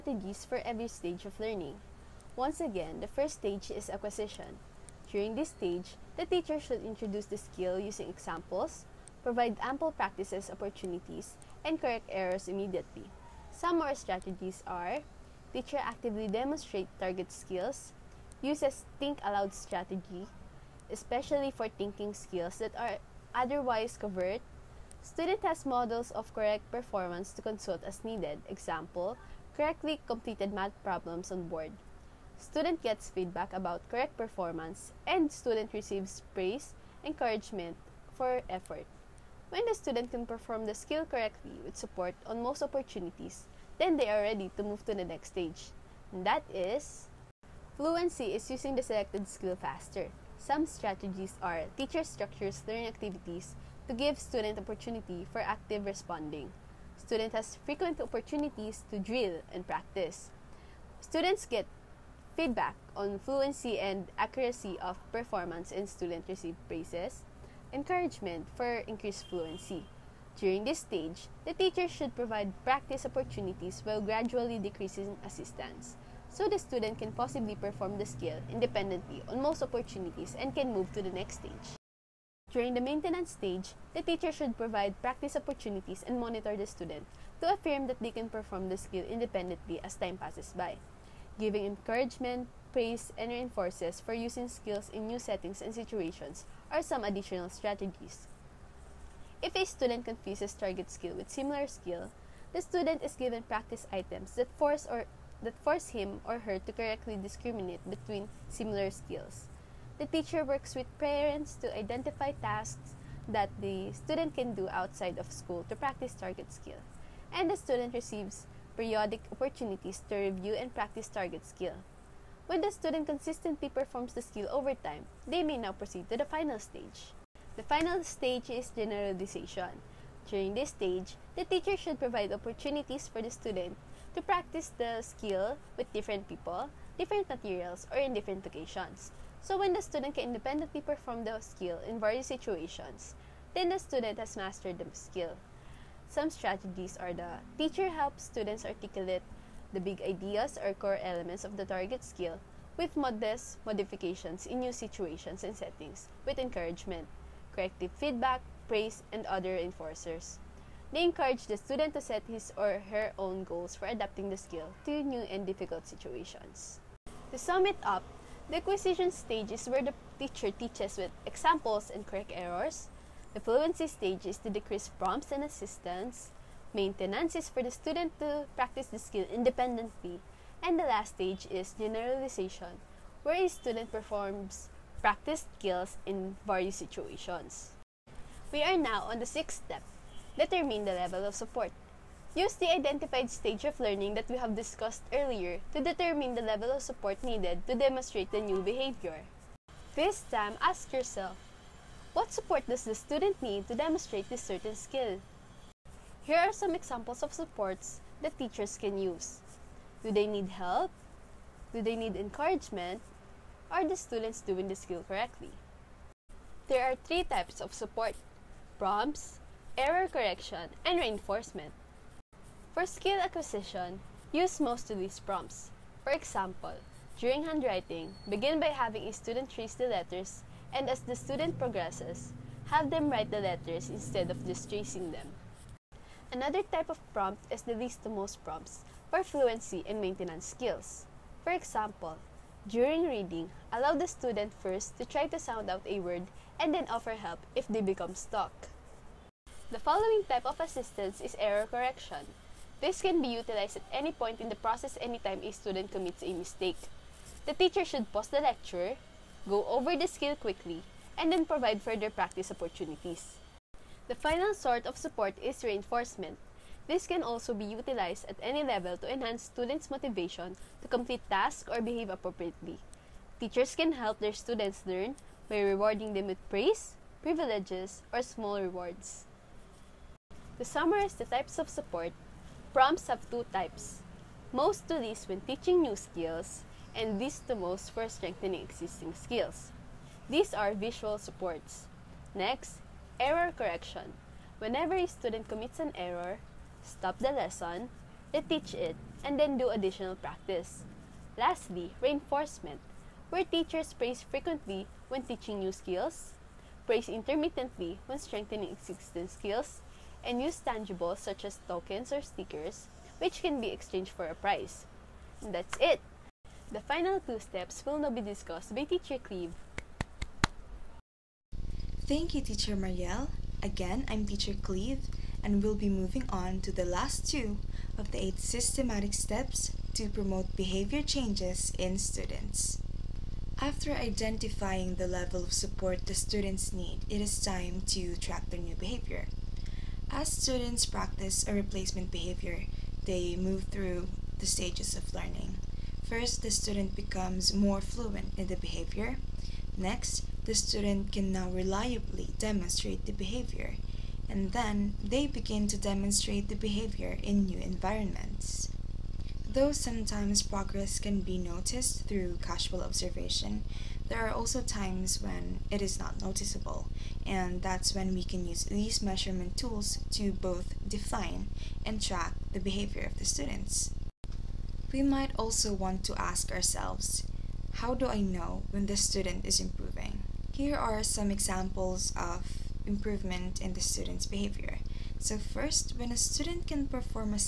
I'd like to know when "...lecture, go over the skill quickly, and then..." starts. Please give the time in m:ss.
4:18.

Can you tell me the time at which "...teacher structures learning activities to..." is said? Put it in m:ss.
0:51.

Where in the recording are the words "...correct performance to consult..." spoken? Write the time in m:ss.
0:26.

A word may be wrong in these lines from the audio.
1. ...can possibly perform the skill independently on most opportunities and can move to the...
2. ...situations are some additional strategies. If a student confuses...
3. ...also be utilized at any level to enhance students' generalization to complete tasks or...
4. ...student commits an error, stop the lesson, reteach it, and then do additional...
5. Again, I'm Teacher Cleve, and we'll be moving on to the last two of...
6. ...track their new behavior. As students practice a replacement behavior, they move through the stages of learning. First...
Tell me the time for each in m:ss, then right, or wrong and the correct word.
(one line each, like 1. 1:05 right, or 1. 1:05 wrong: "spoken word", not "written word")
1. 1:16 right
2. 1:35 right
3. 4:27 wrong: "motivation", not "generalization"
4. 4:55 right
5. 5:23 right
6. 5:38 right.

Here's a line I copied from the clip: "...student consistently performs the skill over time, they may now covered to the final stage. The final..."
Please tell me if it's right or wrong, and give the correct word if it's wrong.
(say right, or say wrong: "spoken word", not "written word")
wrong: "proceed", not "covered".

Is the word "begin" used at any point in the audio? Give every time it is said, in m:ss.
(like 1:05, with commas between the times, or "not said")
3:48, 5:55.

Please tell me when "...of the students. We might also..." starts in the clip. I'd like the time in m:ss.
6:13.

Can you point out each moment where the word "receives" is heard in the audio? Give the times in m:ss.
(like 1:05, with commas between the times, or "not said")
0:35, 1:06, 1:57.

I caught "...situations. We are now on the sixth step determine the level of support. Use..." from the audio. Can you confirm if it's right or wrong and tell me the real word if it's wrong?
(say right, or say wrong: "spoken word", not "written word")
right.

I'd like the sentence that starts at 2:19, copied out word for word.
So when the student can independently perform the skill in various situations, then the student has mastered the skill.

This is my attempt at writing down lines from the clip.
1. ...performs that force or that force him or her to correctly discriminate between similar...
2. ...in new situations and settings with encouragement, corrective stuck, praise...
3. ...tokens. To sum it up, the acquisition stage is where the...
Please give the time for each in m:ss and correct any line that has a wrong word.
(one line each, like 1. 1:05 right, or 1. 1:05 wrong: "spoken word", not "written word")
1. 1:43 wrong: "items", not "performs"
2. 2:34 wrong: "feedback", not "stuck"
3. 2:45 wrong: "situations", not "tokens".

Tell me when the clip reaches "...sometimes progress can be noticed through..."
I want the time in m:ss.
5:59.